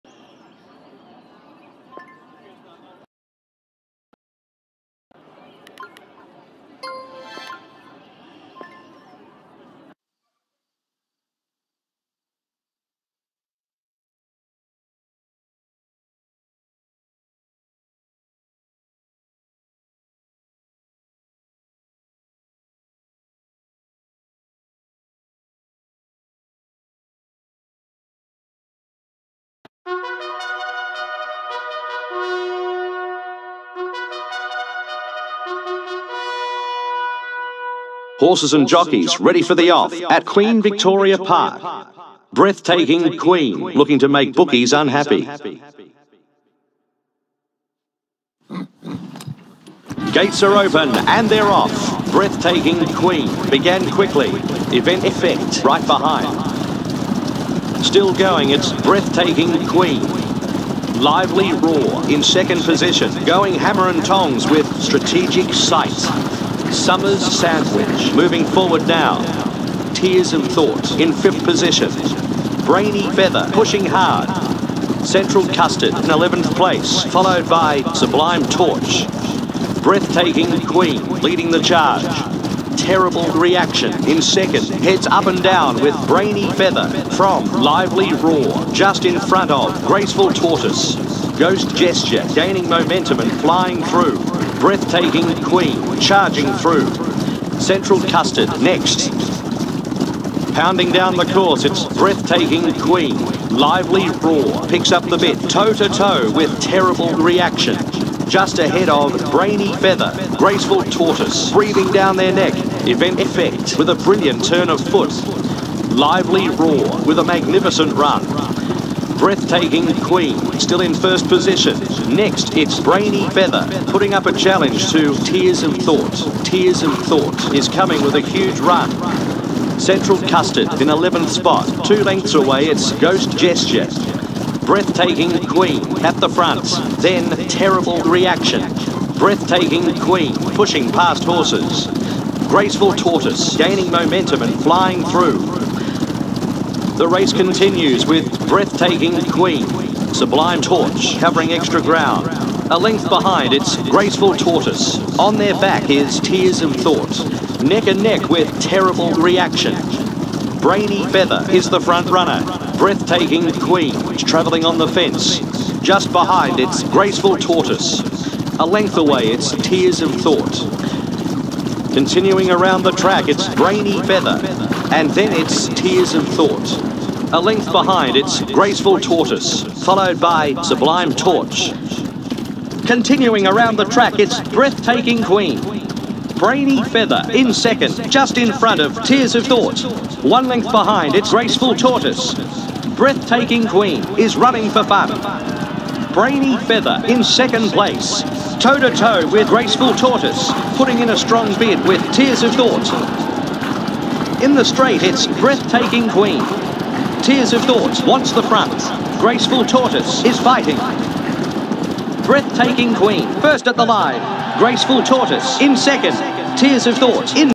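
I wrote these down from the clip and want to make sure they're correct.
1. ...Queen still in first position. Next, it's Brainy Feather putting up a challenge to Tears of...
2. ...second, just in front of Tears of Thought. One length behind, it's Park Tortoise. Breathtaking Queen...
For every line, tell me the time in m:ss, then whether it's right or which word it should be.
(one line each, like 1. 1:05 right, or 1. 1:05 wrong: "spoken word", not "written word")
1. 2:00 right
2. 3:07 wrong: "Graceful", not "Park".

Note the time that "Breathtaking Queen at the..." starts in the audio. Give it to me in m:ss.
2:14.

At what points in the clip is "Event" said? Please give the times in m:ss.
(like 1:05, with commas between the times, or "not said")
0:54, 1:52.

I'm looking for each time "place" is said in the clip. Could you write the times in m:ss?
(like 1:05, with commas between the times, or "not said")
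1:16, 3:17.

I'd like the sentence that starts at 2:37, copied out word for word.
Neck and neck with terrible reaction.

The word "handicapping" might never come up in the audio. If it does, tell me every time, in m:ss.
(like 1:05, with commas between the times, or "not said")
not said.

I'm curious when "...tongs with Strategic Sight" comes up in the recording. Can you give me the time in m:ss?
1:04.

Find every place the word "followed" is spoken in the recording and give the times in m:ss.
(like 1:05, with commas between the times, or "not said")
1:17, 2:59.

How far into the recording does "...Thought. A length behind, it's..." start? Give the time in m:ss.
2:56.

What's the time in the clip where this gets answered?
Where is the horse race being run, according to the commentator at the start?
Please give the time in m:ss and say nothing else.
0:40.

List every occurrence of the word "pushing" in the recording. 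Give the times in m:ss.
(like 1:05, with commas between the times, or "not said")
1:13, 2:20.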